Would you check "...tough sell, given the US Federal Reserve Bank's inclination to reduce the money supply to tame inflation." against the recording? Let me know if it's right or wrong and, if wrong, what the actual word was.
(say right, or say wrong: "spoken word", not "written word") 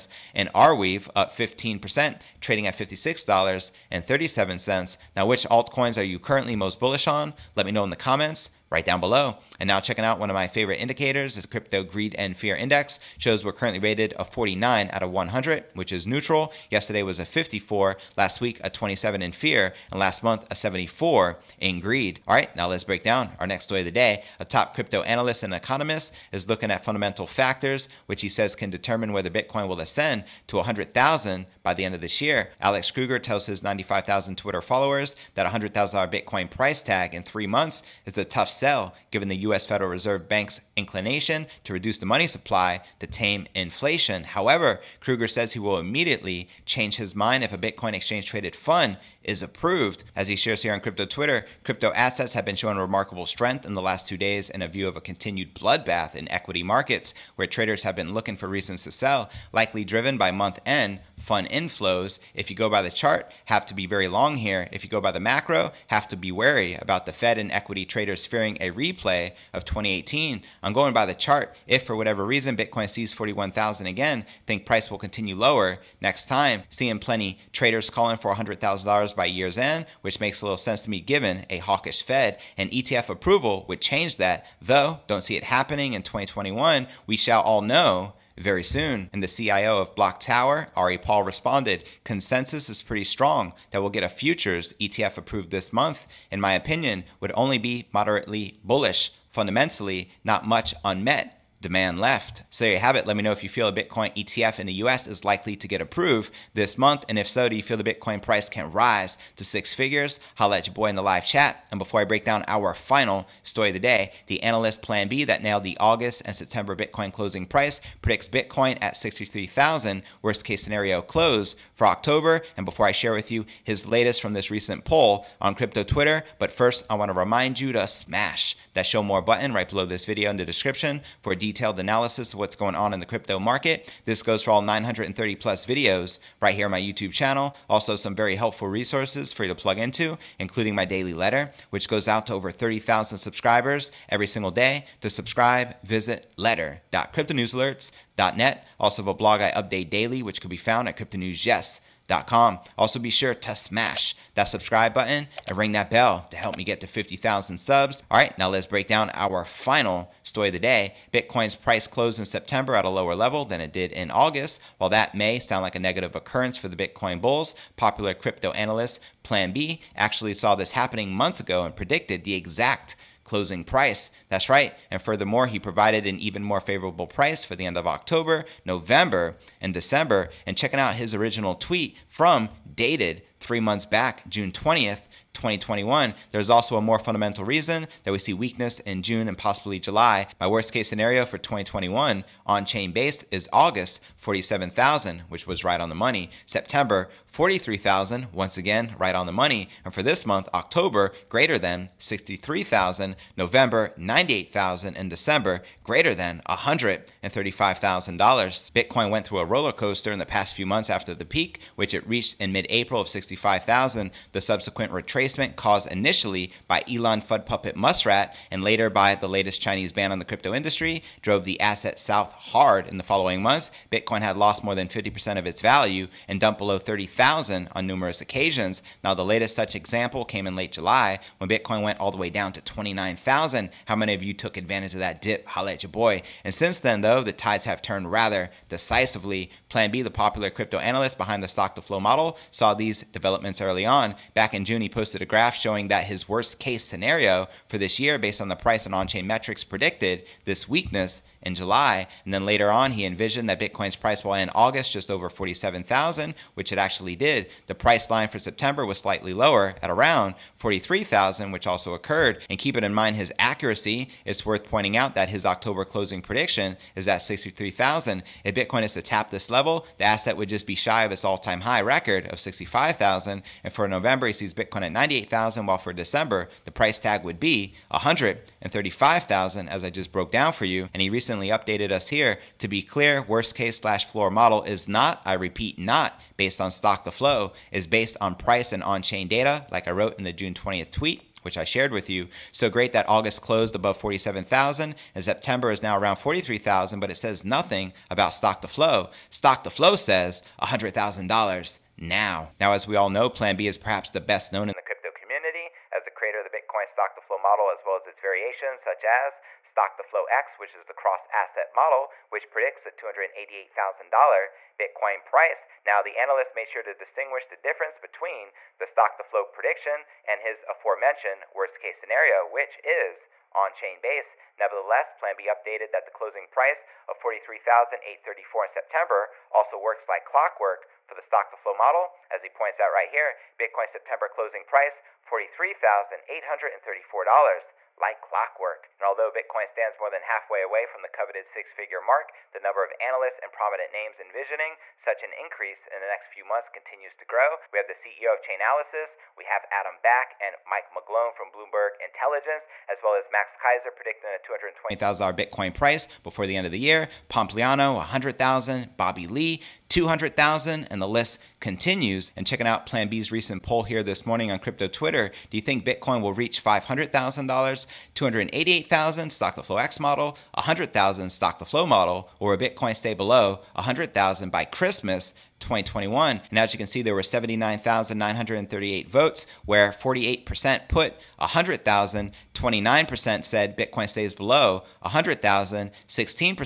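right.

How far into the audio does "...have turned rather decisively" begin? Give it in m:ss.
3:57.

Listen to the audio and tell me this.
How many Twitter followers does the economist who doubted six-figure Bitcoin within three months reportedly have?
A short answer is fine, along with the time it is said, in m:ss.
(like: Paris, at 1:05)
95,000, at 0:33.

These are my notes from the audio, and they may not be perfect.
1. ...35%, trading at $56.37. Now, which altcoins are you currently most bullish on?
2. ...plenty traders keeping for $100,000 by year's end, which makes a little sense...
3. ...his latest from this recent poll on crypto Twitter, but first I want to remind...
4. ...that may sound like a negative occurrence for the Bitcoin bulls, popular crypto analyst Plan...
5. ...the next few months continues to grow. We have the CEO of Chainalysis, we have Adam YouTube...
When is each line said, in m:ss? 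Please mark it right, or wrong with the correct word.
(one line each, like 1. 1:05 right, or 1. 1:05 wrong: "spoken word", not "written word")
1. 0:01 wrong: "15", not "35"
2. 1:16 wrong: "calling", not "keeping"
3. 2:03 right
4. 2:44 right
5. 5:45 wrong: "Back", not "YouTube".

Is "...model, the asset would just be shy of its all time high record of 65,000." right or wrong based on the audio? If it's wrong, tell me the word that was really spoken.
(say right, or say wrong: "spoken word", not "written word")
wrong: "level", not "model".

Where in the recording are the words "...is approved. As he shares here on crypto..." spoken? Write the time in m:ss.
0:49.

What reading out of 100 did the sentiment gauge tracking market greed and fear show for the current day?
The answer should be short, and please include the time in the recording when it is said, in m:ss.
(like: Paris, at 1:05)
49, at 0:14.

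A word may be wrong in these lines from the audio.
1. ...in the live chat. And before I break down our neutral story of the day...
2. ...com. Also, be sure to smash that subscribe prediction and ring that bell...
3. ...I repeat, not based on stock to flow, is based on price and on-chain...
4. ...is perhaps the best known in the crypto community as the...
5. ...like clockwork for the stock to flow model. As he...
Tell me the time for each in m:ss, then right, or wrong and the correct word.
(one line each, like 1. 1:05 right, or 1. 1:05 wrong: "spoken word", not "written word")
1. 1:50 wrong: "final", not "neutral"
2. 2:32 wrong: "button", not "prediction"
3. 4:45 right
4. 5:03 right
5. 5:30 right.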